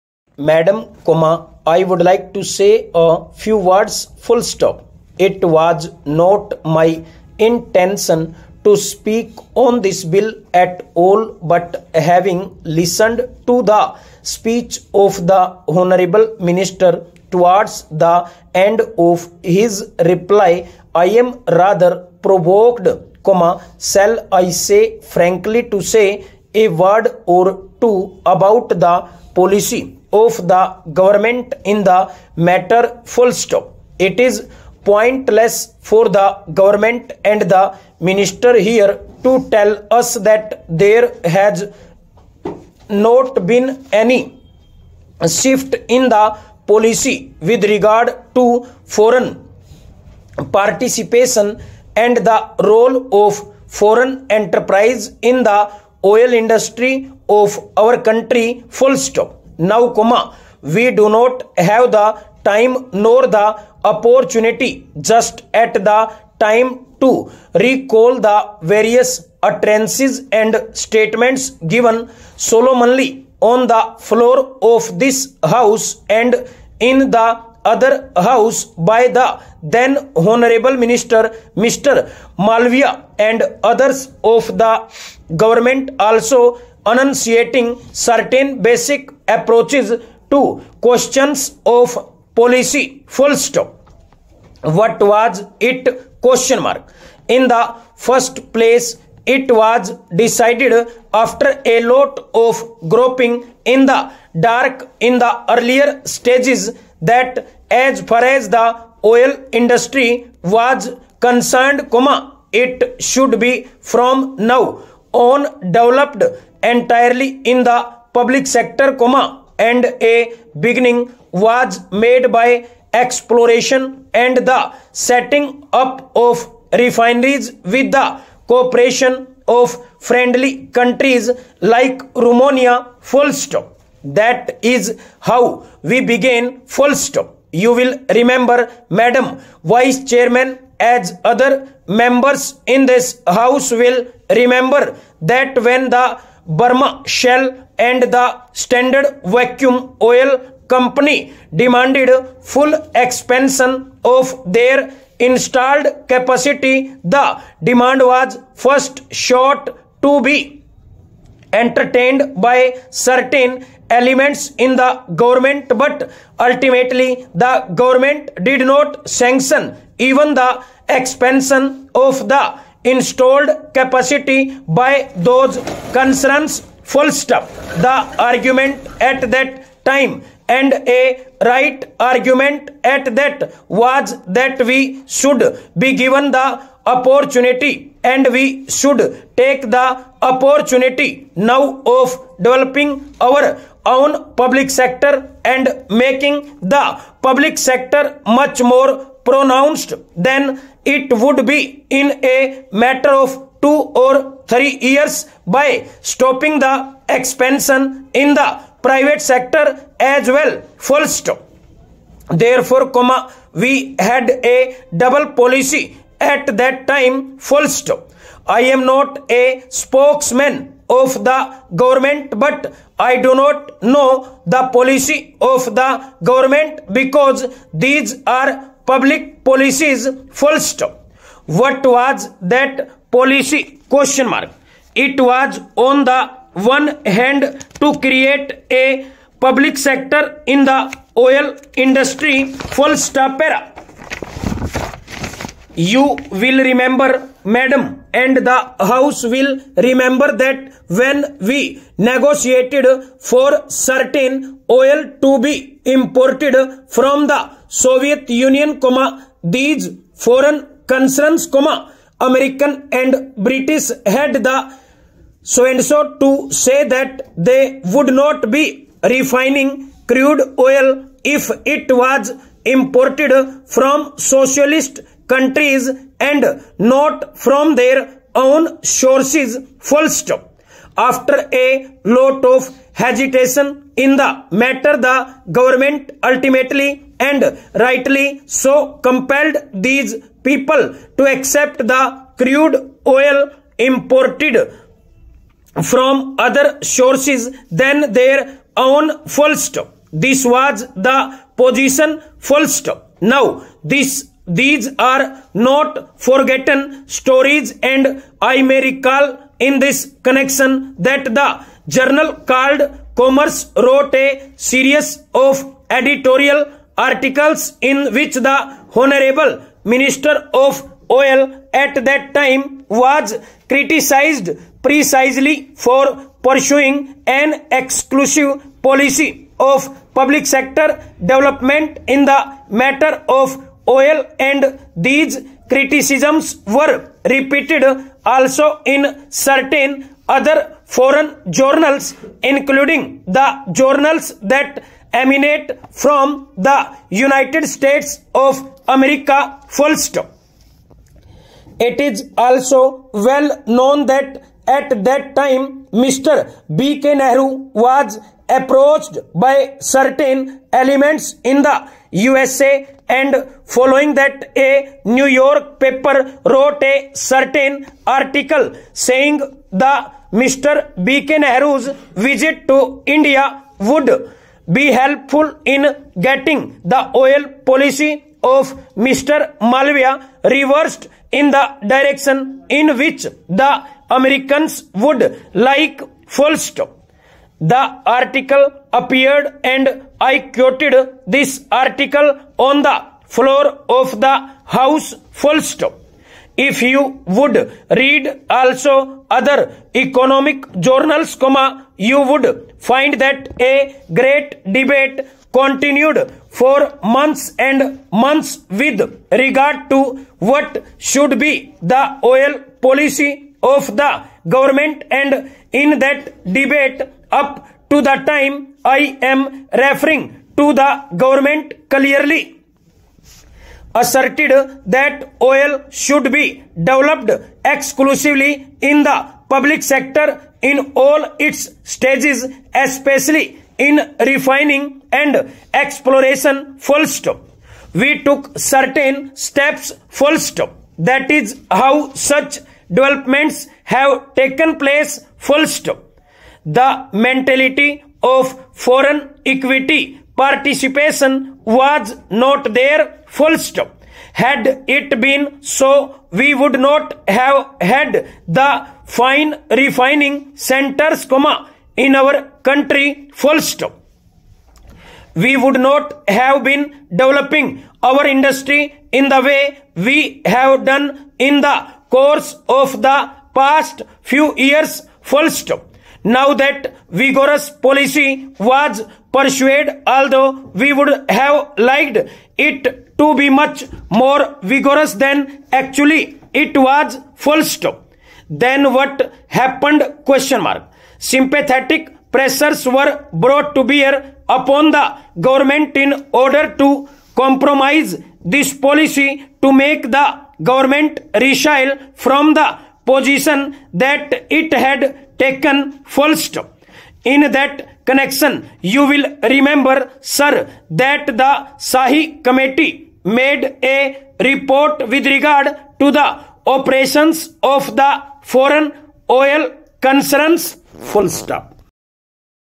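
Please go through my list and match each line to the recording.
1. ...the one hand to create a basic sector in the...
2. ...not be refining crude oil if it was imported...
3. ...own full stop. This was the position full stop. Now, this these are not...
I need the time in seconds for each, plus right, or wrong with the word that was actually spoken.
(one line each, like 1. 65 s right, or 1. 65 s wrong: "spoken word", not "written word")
1. 236 s wrong: "public", not "basic"
2. 268 s right
3. 298 s right.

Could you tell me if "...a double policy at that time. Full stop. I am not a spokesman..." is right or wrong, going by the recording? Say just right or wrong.
right.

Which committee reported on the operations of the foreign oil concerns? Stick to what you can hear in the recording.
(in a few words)
Sahi committee.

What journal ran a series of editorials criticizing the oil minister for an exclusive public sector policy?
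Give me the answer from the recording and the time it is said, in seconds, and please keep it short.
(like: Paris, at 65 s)
Commerce, at 313 s.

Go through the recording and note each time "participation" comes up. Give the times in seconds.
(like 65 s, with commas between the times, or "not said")
50 s, 450 s.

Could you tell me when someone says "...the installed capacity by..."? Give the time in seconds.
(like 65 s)
172 s.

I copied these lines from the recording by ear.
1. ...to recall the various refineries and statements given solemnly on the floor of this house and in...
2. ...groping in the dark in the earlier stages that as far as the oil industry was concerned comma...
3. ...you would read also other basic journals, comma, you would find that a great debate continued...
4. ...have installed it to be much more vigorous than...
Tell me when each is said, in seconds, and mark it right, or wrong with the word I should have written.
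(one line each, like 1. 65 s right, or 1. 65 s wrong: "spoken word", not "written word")
1. 67 s wrong: "utterances", not "refineries"
2. 102 s right
3. 396 s wrong: "economic", not "basic"
4. 481 s wrong: "liked", not "installed".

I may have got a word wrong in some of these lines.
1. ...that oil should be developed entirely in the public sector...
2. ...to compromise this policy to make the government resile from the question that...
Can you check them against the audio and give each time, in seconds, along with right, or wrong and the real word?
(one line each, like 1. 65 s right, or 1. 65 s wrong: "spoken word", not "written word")
1. 424 s wrong: "exclusively", not "entirely"
2. 496 s wrong: "position", not "question".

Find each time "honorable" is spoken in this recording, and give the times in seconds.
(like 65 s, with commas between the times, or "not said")
15 s, 80 s, 319 s.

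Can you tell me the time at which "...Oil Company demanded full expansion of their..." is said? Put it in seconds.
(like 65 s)
150 s.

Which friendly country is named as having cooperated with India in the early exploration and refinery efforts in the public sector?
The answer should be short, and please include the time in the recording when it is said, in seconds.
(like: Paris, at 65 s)
Romania, at 132 s.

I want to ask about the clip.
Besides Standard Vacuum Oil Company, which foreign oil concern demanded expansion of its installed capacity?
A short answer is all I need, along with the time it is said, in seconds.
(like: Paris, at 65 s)
Burma Shell, at 146 s.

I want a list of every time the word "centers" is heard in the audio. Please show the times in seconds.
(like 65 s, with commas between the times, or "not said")
460 s.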